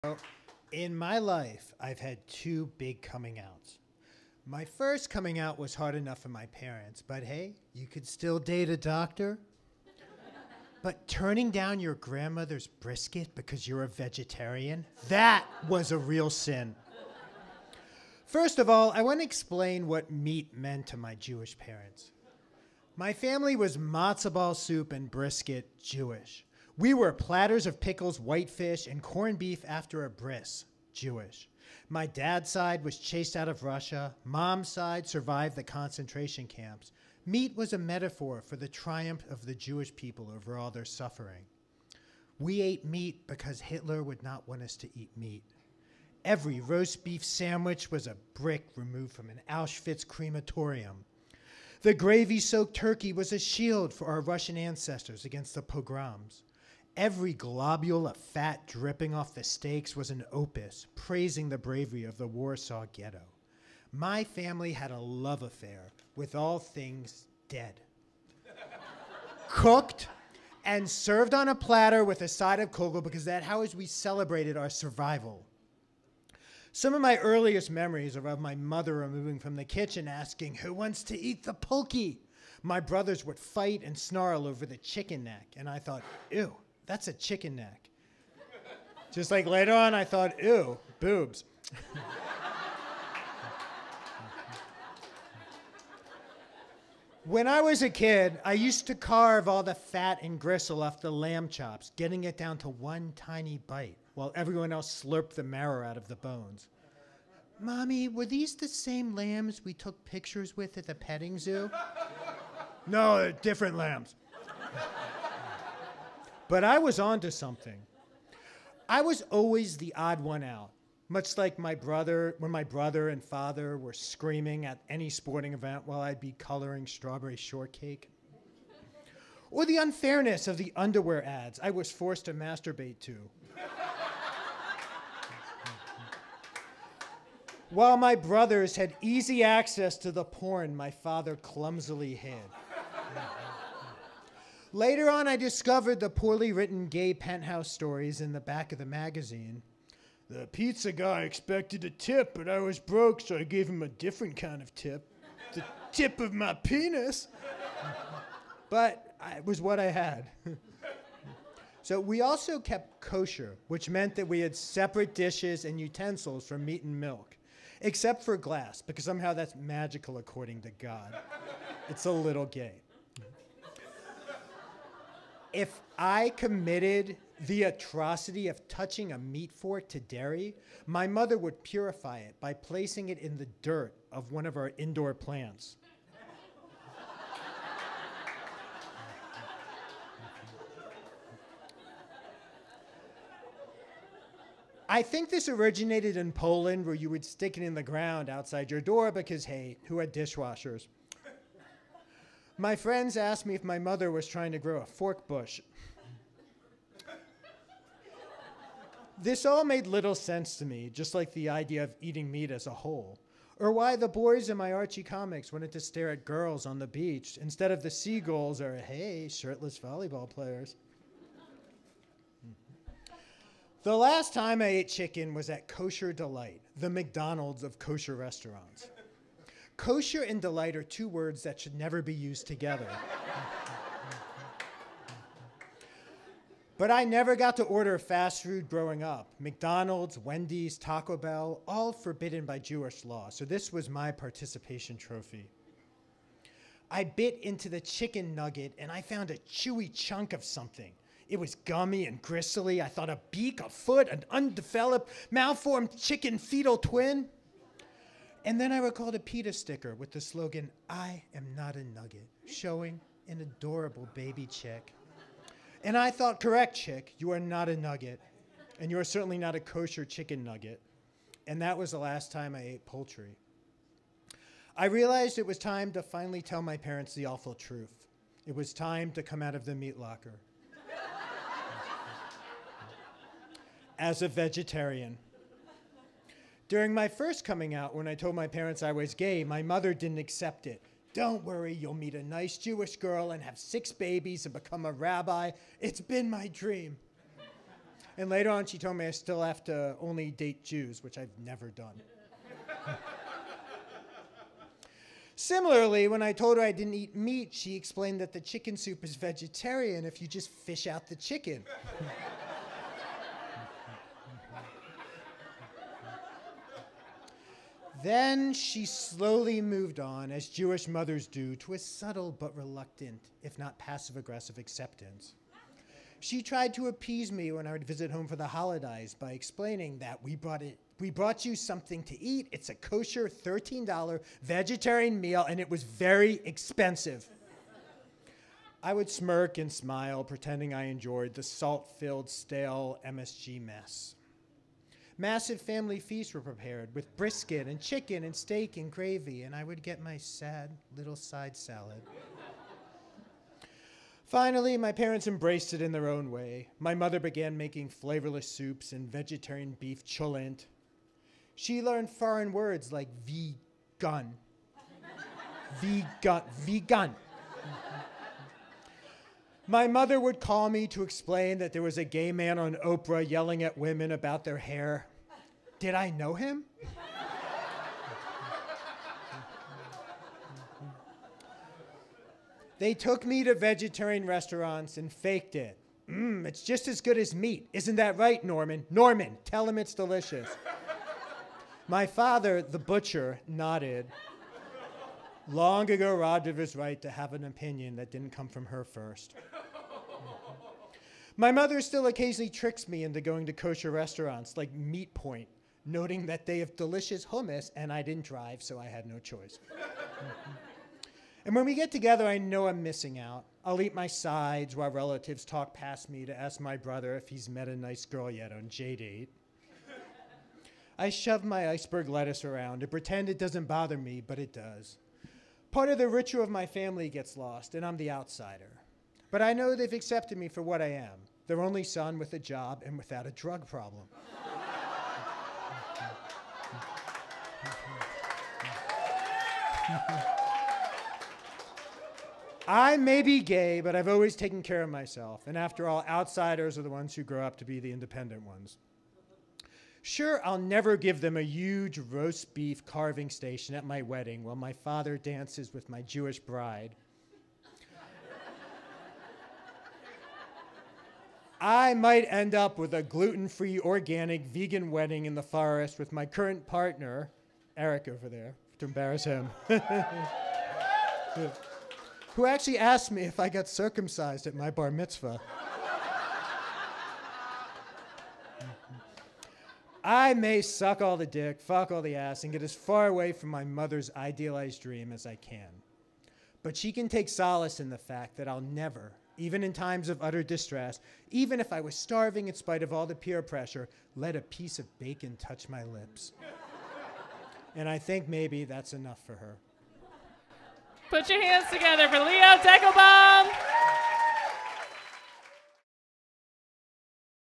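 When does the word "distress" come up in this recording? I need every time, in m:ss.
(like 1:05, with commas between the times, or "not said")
8:10.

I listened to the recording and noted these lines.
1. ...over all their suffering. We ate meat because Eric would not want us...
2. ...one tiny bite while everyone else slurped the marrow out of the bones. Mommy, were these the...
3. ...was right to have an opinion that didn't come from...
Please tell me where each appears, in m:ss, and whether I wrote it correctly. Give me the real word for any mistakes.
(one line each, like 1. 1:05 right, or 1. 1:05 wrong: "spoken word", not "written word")
1. 0:40 wrong: "Hitler", not "Eric"
2. 1:42 right
3. 6:36 right.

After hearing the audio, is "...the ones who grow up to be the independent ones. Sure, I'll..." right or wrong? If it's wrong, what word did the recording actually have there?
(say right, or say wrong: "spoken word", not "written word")
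right.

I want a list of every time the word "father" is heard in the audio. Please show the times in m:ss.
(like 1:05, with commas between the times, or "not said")
2:03, 2:20, 6:32, 7:34.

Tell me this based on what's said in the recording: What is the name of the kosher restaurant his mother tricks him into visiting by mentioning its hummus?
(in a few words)
Meat Point.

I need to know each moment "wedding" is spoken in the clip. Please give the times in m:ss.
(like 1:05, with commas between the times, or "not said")
7:34, 7:44.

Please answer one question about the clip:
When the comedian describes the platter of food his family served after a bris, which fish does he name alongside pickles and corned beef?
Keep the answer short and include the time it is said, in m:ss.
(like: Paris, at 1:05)
Whitefish, at 0:28.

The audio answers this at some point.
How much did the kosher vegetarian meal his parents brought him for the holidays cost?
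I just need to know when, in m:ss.
5:33.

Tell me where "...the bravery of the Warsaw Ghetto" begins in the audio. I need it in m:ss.
1:01.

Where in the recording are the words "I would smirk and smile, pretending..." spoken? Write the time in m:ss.
5:38.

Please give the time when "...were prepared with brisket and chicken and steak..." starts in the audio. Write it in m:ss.
5:46.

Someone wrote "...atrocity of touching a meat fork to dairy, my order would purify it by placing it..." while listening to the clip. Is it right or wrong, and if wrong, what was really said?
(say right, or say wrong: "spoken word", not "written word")
wrong: "mother", not "order".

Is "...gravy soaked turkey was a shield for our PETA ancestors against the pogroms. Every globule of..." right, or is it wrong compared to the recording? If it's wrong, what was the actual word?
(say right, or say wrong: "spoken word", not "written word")
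wrong: "Russian", not "PETA".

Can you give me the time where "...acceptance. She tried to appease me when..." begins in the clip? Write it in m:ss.
5:24.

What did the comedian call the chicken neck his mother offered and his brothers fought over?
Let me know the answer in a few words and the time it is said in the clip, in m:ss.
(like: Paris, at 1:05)
Pulky, at 1:21.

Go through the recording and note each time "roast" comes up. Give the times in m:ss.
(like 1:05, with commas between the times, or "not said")
0:46, 7:31.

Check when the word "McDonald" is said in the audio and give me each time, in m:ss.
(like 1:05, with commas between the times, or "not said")
3:46, 3:59.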